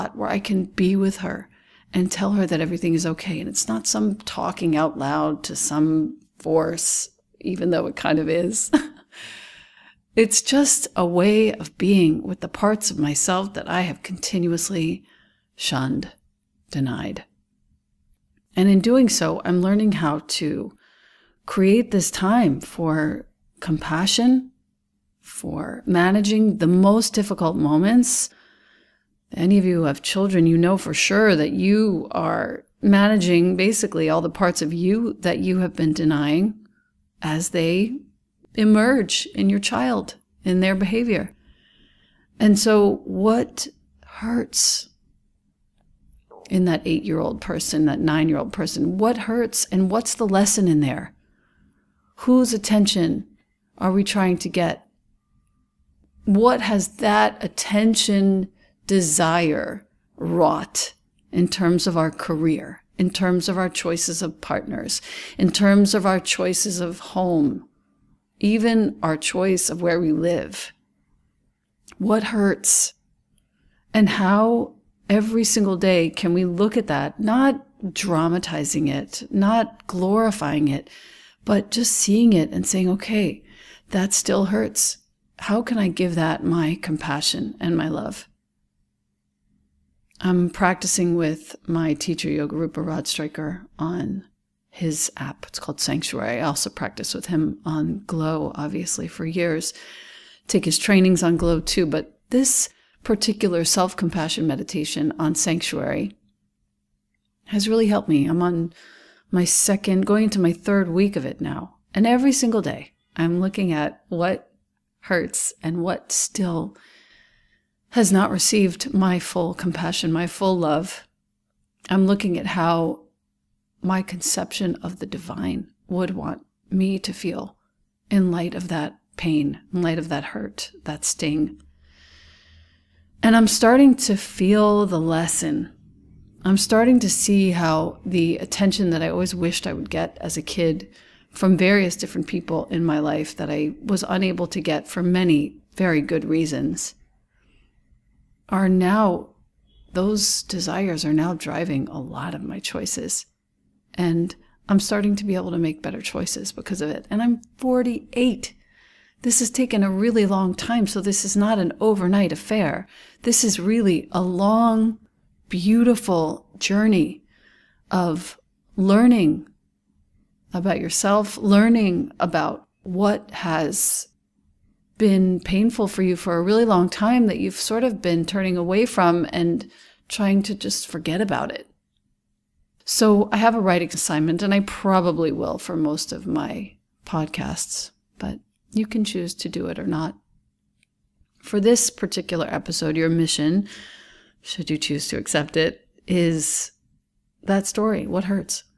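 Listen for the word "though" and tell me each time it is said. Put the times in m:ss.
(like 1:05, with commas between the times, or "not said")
0:07.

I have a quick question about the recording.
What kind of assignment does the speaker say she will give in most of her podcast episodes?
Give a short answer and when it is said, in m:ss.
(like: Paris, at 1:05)
writing assignment, at 3:03.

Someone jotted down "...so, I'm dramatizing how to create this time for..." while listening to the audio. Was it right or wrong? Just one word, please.
wrong.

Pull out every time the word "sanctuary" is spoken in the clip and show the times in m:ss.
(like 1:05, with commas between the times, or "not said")
1:35, 1:45.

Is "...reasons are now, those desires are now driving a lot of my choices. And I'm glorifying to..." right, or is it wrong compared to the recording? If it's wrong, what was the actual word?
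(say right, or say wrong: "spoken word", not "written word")
wrong: "starting", not "glorifying".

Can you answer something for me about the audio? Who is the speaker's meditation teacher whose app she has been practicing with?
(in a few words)
Yogarupa Rod Stryker.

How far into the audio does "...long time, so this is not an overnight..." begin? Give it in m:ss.
2:40.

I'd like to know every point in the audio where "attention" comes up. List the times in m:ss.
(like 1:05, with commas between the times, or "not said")
0:52, 0:57, 2:18.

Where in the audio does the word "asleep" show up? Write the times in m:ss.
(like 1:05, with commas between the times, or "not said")
not said.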